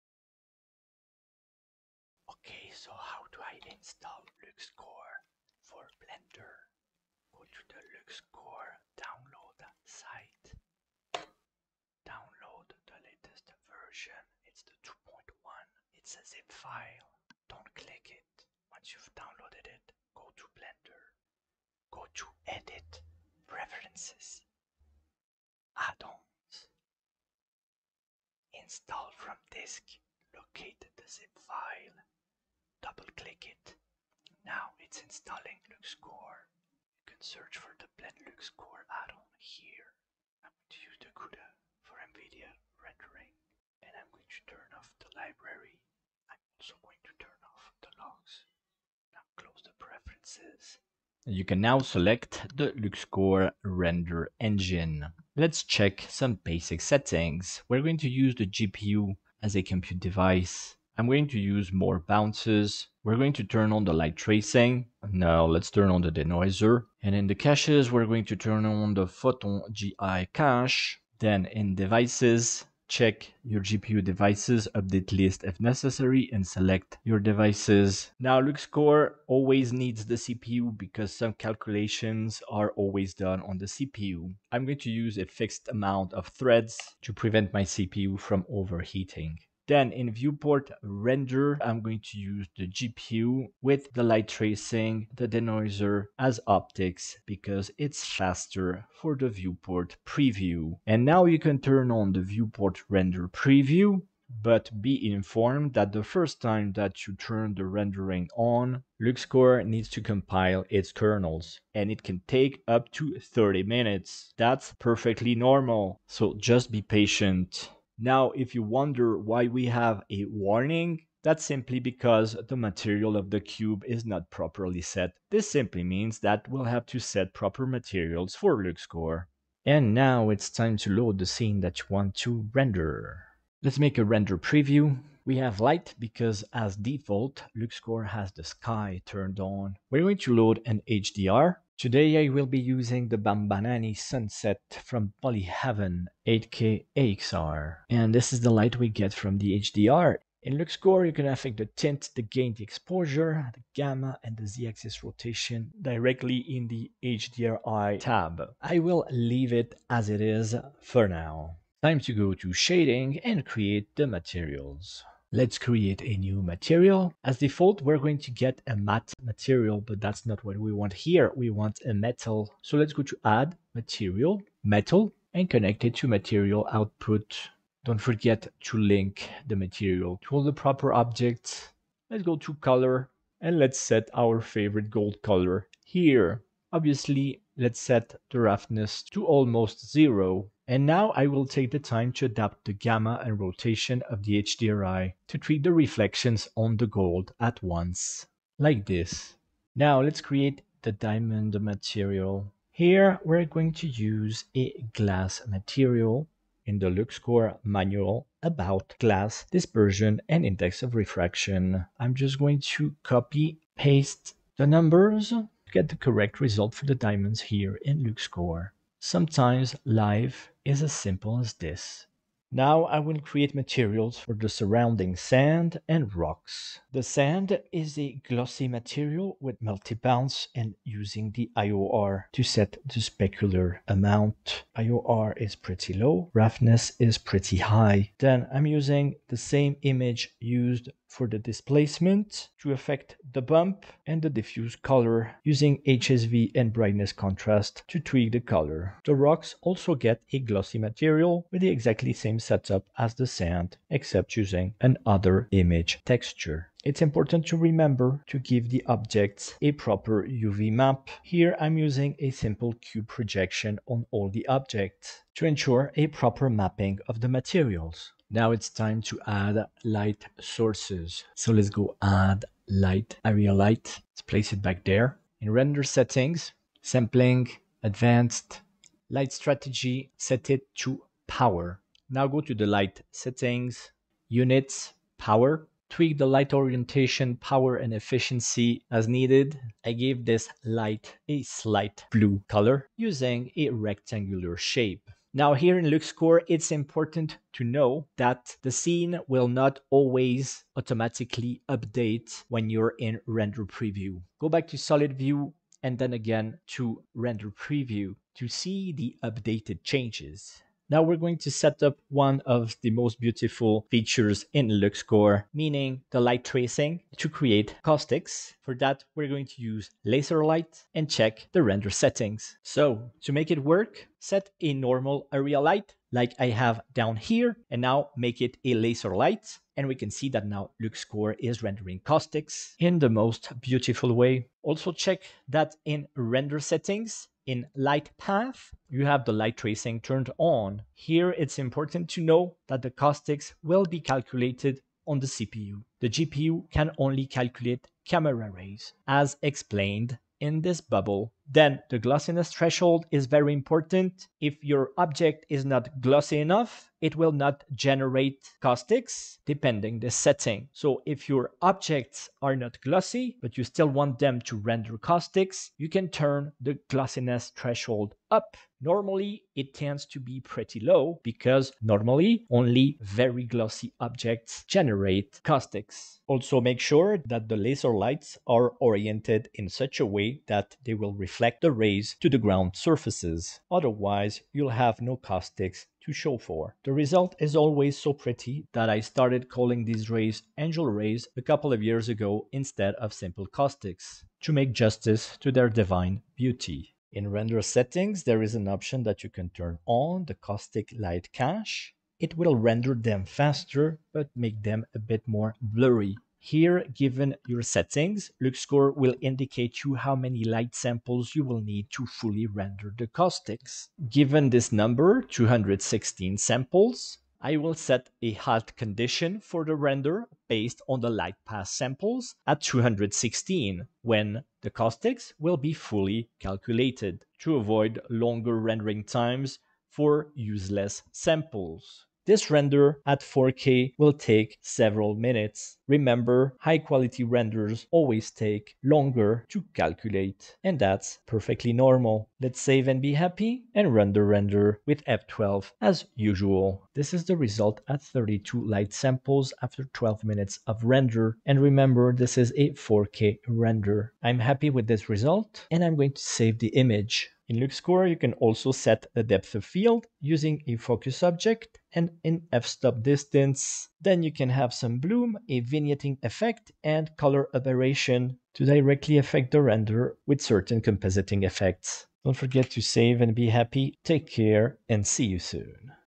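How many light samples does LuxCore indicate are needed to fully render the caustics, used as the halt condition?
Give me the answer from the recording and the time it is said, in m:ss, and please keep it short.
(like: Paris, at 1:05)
216, at 6:55.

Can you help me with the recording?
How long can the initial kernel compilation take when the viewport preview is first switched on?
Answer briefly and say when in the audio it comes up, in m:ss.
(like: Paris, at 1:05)
30 minutes, at 1:53.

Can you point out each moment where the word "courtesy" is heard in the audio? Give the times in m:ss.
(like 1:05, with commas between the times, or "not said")
not said.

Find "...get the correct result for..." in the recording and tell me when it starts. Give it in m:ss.
3:35.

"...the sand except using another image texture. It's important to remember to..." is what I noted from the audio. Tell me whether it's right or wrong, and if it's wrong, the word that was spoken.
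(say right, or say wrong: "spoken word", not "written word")
right.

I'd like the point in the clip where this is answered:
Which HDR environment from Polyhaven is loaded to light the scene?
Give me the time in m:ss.
2:23.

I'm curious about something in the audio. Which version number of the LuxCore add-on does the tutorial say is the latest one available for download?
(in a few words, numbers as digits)
2.1.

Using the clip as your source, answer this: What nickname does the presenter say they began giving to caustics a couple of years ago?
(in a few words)
angel rays.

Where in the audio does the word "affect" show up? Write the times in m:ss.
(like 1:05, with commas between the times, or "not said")
2:31, 4:02, 7:49.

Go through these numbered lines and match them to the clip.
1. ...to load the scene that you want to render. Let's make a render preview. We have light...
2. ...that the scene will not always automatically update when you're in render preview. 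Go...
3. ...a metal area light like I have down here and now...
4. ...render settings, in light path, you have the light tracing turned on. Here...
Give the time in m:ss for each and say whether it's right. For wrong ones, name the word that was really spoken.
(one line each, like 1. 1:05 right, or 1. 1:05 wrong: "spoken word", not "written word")
1. 2:10 right
2. 4:58 right
3. 5:24 wrong: "normal", not "metal"
4. 5:36 right.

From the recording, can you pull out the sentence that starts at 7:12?
This render at 4K will take several minutes.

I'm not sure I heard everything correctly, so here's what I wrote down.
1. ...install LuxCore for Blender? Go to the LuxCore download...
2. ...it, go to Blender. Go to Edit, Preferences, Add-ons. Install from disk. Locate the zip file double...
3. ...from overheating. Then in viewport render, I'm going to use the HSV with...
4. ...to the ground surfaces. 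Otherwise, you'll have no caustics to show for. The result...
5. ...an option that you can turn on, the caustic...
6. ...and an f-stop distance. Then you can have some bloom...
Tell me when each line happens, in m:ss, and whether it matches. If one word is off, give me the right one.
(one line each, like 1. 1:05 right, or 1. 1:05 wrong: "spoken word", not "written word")
1. 0:03 right
2. 0:19 right
3. 1:28 wrong: "GPU", not "HSV"
4. 6:22 right
5. 6:38 right
6. 7:41 right.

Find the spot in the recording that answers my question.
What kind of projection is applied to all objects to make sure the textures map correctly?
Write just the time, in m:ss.
4:22.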